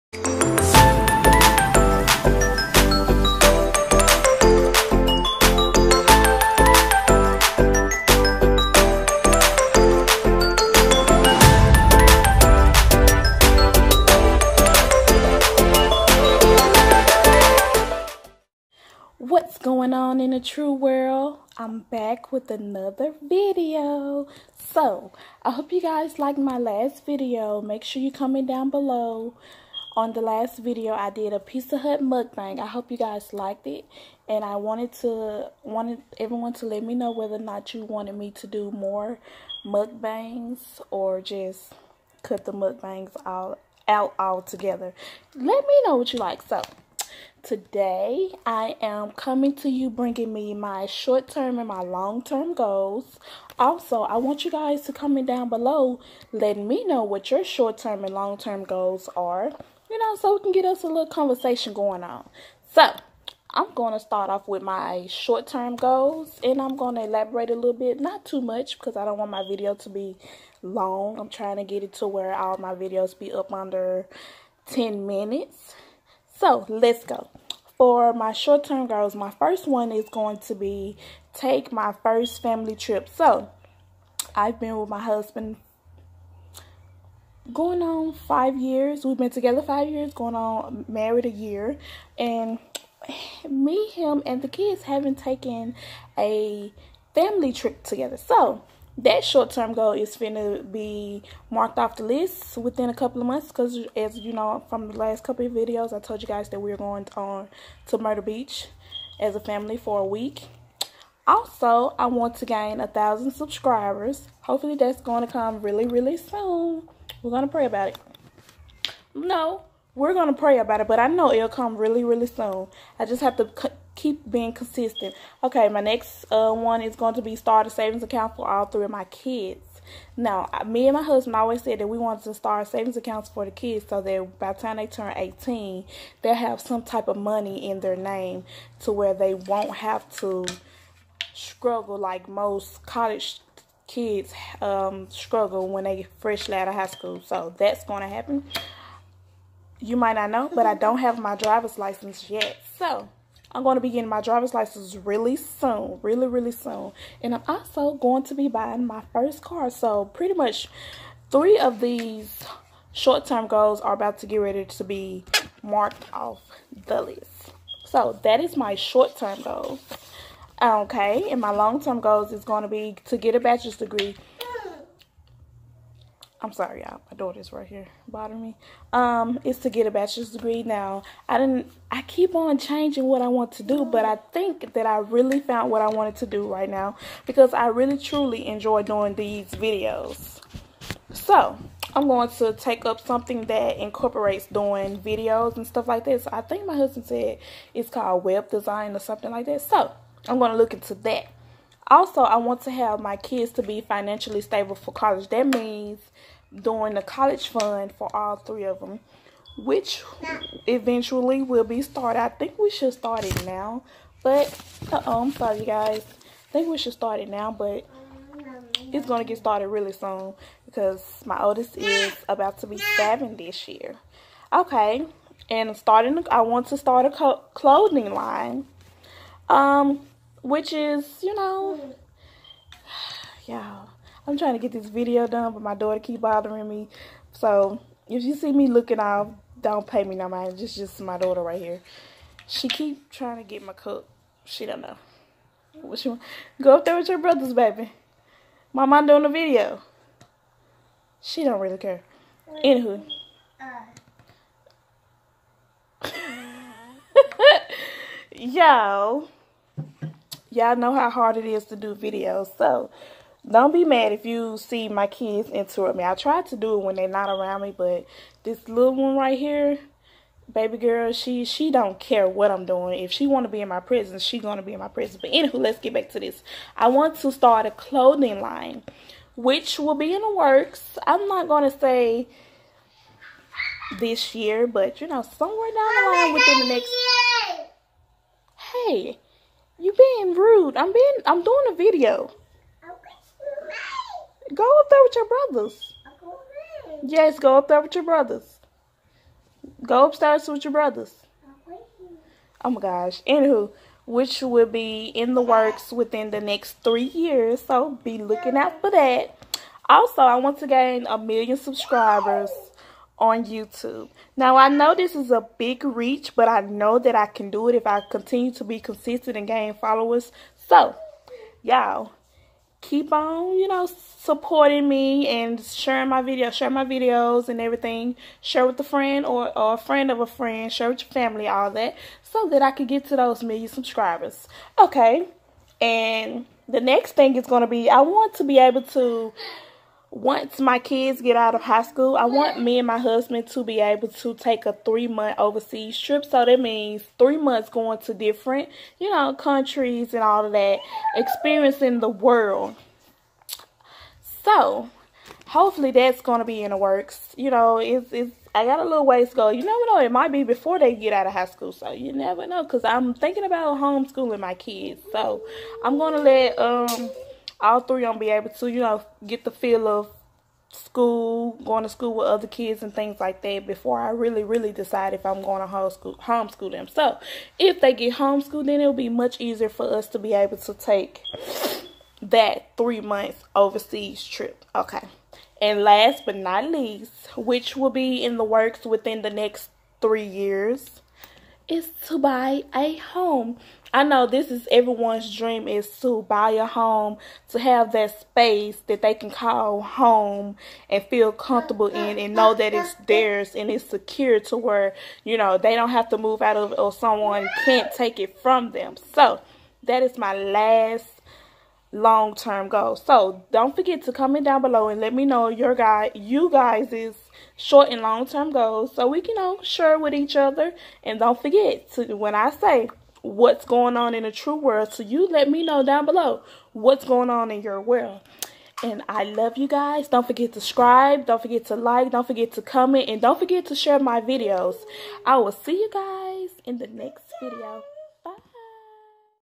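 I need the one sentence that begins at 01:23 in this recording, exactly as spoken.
So I've been with my husband going on five years.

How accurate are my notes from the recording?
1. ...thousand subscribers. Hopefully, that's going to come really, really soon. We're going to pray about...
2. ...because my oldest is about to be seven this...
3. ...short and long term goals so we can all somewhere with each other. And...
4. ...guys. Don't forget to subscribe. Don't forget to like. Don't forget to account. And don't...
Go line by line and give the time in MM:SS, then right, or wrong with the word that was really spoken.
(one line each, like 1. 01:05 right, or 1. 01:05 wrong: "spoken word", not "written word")
1. 01:52 right
2. 03:40 right
3. 06:57 wrong: "share", not "somewhere"
4. 07:09 wrong: "comment", not "account".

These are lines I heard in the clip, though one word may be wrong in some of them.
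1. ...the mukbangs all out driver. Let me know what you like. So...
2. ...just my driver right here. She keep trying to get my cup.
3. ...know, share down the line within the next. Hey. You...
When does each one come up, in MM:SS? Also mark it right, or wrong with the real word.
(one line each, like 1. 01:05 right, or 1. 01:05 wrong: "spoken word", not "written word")
1. 00:42 wrong: "altogether", not "driver"
2. 04:00 wrong: "daughter", not "driver"
3. 04:45 wrong: "somewhere", not "share".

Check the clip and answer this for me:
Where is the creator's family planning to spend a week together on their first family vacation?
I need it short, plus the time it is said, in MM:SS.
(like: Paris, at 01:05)
Myrtle Beach, at 01:47.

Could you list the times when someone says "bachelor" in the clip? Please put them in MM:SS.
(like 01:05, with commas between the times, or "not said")
02:53, 02:59.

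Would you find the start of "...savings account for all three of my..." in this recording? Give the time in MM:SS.
02:07.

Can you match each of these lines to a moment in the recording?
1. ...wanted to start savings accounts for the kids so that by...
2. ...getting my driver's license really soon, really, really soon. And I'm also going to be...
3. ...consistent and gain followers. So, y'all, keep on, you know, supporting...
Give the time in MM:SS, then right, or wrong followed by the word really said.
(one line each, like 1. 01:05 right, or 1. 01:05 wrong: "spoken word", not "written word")
1. 02:11 right
2. 02:33 right
3. 05:18 right.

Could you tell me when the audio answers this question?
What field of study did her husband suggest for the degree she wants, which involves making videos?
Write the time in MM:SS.
03:18.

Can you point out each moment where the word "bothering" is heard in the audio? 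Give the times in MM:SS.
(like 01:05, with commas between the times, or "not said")
02:58, 03:56.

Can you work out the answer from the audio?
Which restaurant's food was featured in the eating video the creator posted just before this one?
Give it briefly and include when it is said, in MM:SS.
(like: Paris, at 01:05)
Pizza Hut, at 00:31.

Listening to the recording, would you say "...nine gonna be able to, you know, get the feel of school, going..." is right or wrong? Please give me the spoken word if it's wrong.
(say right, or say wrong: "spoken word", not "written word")
wrong: "three", not "nine".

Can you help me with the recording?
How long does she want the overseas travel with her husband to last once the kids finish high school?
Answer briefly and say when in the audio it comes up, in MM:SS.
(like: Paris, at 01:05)
3 months, at 05:44.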